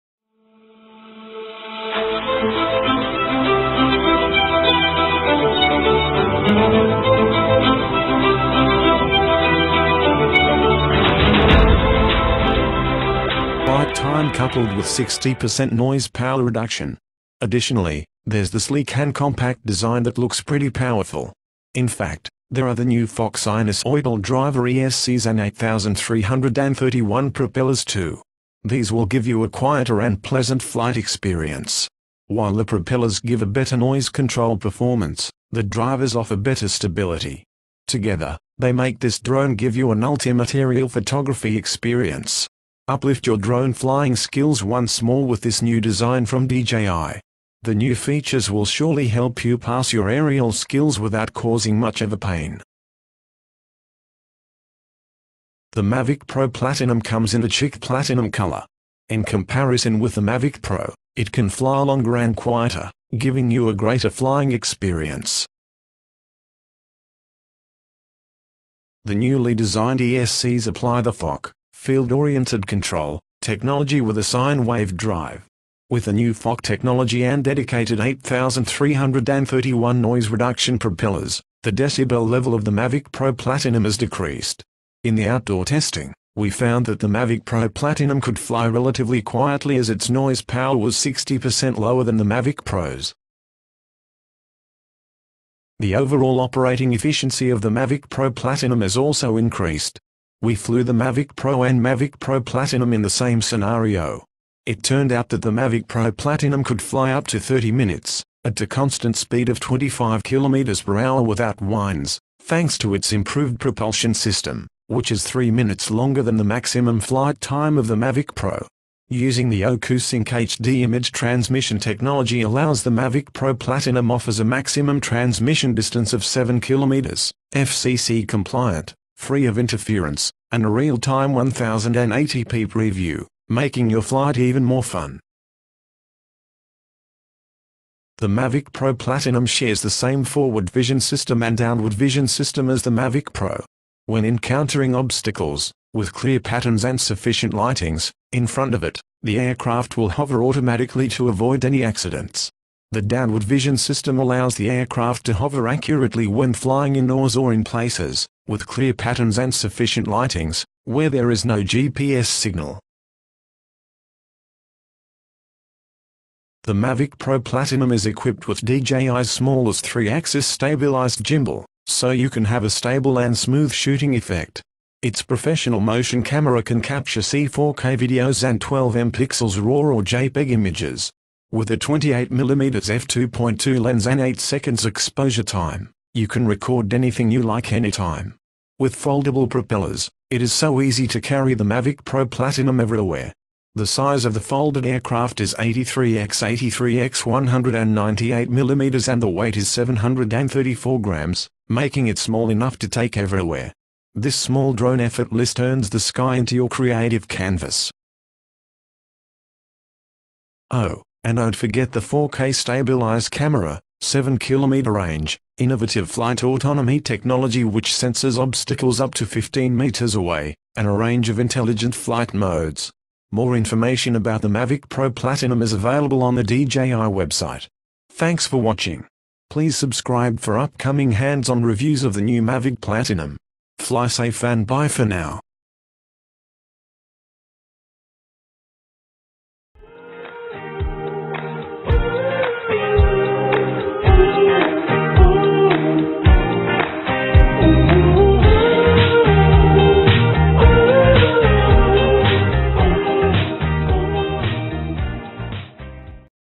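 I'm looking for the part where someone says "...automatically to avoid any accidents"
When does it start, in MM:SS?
02:30.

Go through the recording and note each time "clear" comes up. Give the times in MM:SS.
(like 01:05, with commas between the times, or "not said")
02:26, 02:38.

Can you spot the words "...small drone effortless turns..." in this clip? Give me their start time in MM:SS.
03:24.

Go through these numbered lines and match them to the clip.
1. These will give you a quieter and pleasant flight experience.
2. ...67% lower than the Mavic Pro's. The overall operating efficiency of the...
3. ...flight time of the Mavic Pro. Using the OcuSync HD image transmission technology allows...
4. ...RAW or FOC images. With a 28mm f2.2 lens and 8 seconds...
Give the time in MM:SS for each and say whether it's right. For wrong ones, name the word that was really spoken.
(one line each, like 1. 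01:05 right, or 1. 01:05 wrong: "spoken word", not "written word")
1. 00:28 right
2. 01:30 wrong: "60", not "67"
3. 01:56 right
4. 02:59 wrong: "JPEG", not "FOC".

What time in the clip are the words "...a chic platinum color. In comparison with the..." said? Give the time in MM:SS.
00:57.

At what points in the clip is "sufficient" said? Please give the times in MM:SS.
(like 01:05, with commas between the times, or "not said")
02:26, 02:39.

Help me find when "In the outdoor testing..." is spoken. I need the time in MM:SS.
01:25.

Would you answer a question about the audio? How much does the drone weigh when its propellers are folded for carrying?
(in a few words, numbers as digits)
734 grams.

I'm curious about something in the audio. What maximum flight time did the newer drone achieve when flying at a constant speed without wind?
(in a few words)
30 minutes.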